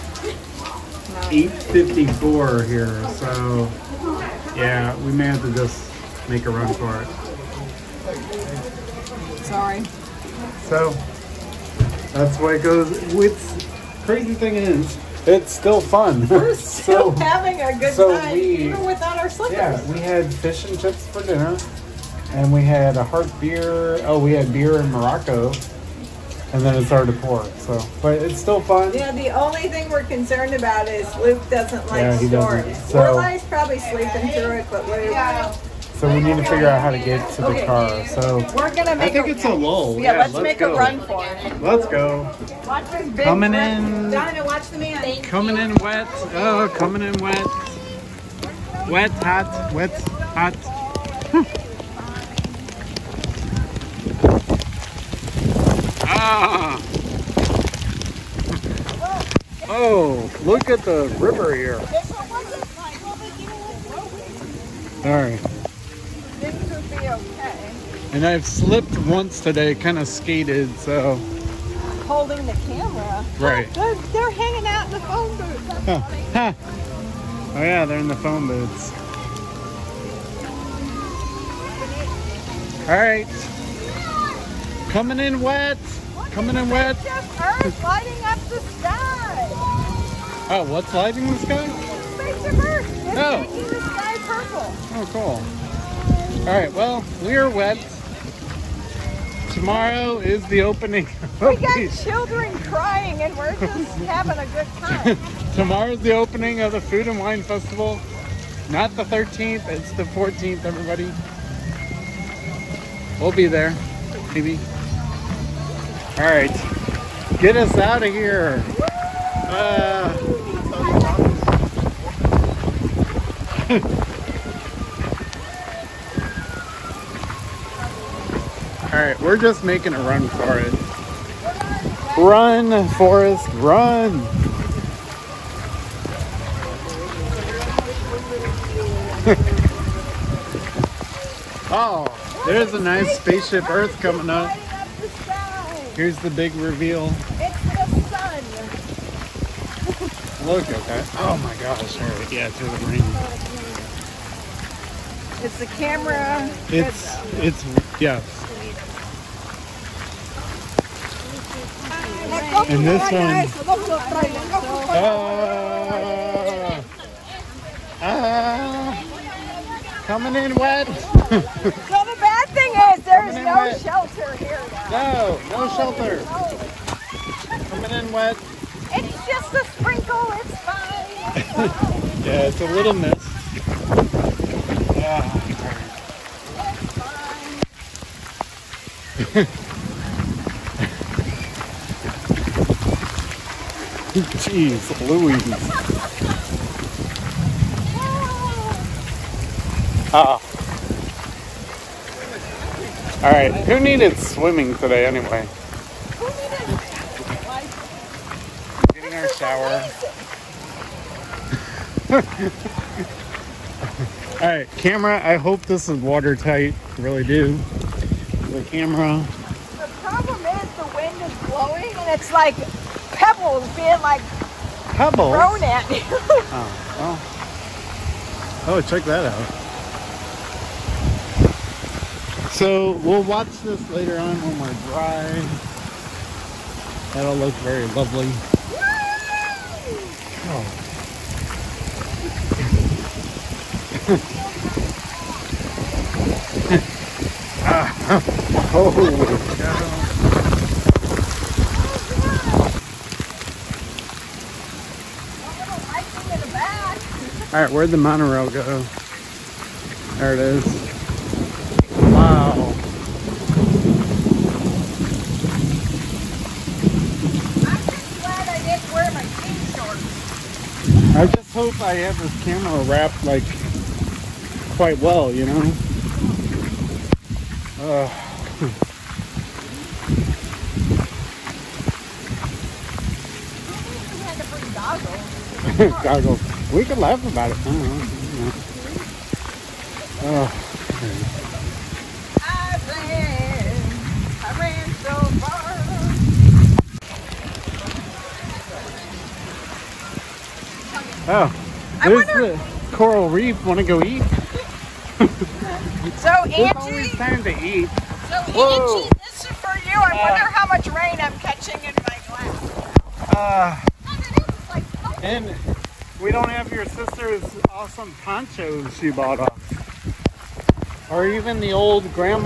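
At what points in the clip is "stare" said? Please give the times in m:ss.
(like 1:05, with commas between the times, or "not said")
not said.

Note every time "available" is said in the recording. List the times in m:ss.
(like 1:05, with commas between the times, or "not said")
not said.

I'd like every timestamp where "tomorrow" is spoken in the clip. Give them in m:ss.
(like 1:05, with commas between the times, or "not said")
1:39, 1:45.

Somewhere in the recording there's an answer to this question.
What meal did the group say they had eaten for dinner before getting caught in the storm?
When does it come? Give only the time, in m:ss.
0:20.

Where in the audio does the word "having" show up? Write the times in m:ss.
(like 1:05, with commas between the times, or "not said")
0:17, 1:44.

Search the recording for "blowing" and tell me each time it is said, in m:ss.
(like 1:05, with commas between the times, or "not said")
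3:41.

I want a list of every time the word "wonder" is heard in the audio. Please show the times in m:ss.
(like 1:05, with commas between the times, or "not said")
5:02, 5:10.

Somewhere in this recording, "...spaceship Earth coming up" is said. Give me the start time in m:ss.
2:23.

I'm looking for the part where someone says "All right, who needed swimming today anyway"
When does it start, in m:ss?
3:23.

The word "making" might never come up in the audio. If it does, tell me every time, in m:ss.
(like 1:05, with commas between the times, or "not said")
1:33, 2:09.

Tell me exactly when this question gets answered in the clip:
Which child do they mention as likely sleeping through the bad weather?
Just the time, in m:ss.
0:32.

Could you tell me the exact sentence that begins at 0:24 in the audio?
Oh, we had beer in Morocco, and then it's hard to pour.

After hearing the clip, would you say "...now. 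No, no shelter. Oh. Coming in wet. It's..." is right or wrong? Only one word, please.
right.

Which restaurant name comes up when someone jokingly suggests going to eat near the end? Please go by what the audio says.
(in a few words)
the coral reef.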